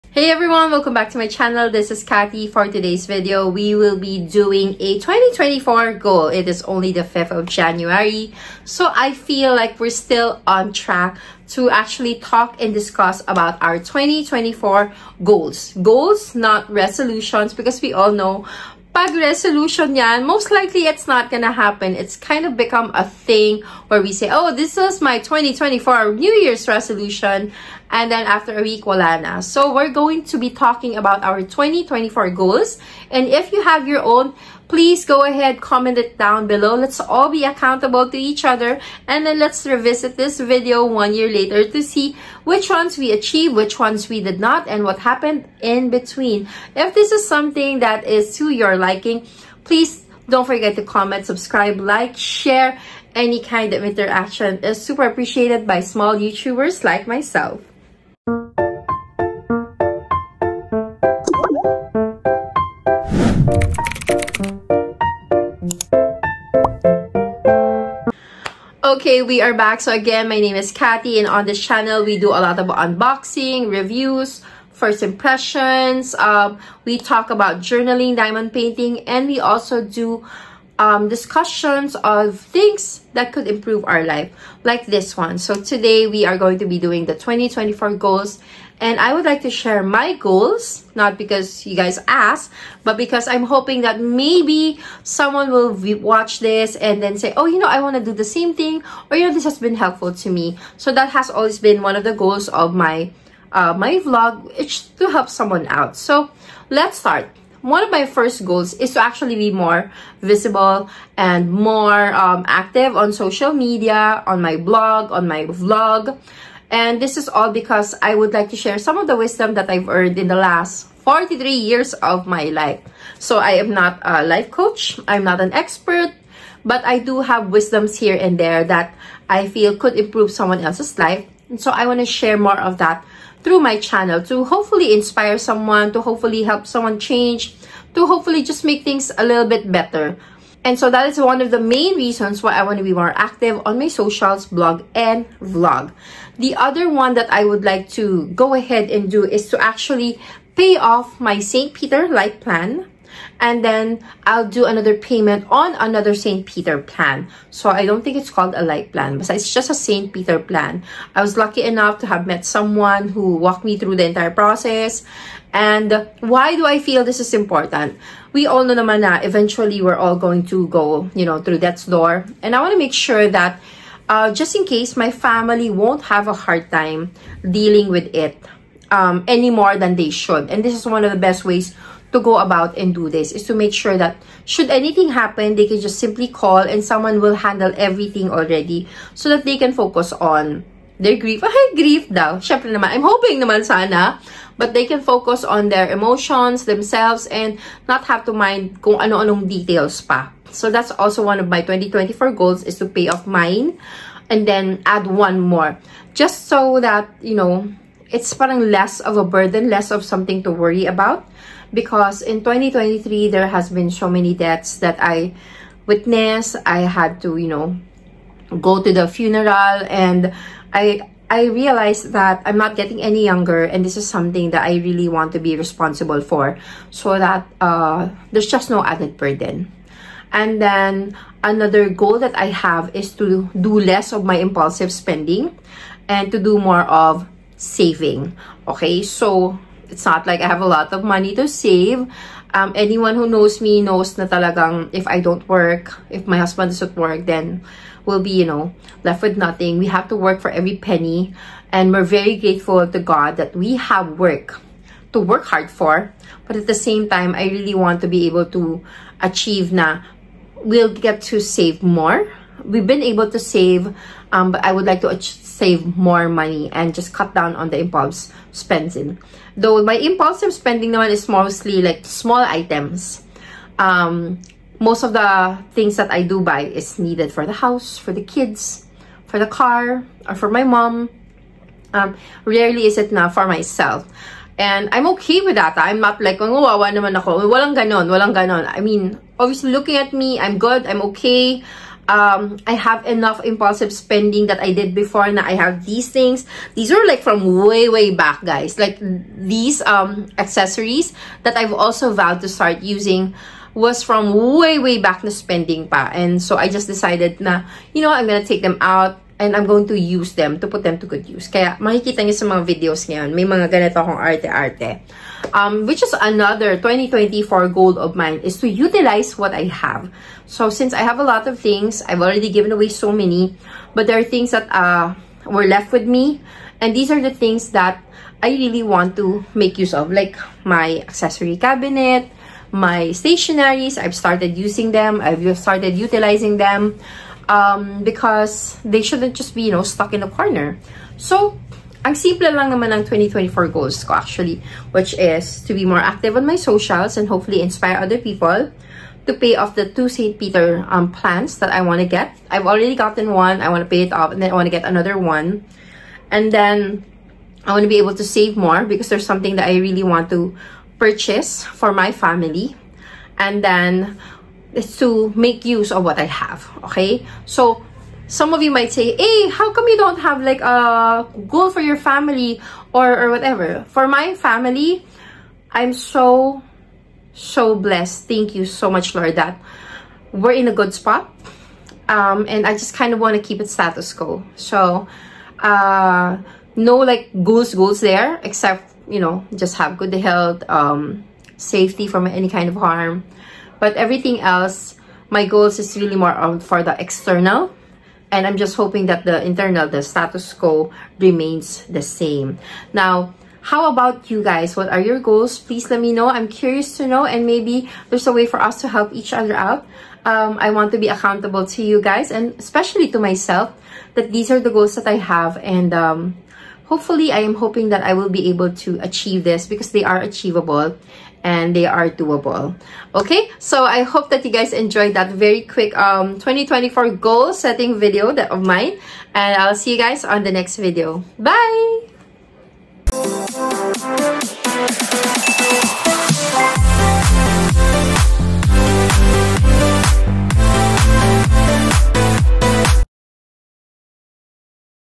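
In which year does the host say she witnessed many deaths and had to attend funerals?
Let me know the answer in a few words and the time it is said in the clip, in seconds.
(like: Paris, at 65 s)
2023, at 212 s.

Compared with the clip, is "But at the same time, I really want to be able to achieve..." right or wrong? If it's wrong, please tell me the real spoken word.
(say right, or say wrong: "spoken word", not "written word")
right.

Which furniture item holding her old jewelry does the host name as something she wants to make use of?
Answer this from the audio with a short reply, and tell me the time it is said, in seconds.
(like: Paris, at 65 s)
Accessory cabinet, at 331 s.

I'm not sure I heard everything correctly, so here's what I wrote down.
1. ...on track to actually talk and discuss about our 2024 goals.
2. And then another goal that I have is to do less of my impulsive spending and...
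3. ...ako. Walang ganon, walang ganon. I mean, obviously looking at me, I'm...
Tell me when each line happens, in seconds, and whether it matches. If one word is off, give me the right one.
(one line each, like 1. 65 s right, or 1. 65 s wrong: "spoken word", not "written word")
1. 10 s right
2. 230 s right
3. 287 s right.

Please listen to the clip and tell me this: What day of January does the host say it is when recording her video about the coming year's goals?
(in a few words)
5th.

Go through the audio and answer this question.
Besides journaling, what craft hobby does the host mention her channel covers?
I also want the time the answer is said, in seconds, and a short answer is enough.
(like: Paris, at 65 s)
Diamond painting, at 78 s.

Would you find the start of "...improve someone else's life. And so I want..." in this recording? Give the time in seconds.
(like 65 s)
129 s.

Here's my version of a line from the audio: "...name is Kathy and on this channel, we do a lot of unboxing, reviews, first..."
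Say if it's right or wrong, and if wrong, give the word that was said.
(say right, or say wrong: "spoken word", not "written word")
right.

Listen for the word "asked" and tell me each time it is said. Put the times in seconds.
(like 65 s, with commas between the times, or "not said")
92 s.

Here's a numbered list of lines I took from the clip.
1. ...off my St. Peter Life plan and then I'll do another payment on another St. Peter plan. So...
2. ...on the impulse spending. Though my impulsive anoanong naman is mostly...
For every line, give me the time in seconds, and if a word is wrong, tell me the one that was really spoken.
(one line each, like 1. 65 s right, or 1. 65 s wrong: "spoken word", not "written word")
1. 150 s right
2. 267 s wrong: "spending", not "anoanong".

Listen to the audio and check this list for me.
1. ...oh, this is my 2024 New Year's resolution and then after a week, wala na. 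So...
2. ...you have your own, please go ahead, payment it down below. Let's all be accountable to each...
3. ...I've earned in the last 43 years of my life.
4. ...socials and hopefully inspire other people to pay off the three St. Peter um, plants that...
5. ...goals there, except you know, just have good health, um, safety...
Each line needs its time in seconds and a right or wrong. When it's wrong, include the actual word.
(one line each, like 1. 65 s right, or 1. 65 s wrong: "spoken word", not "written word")
1. 24 s right
2. 33 s wrong: "comment", not "payment"
3. 119 s right
4. 346 s wrong: "two", not "three"
5. 387 s right.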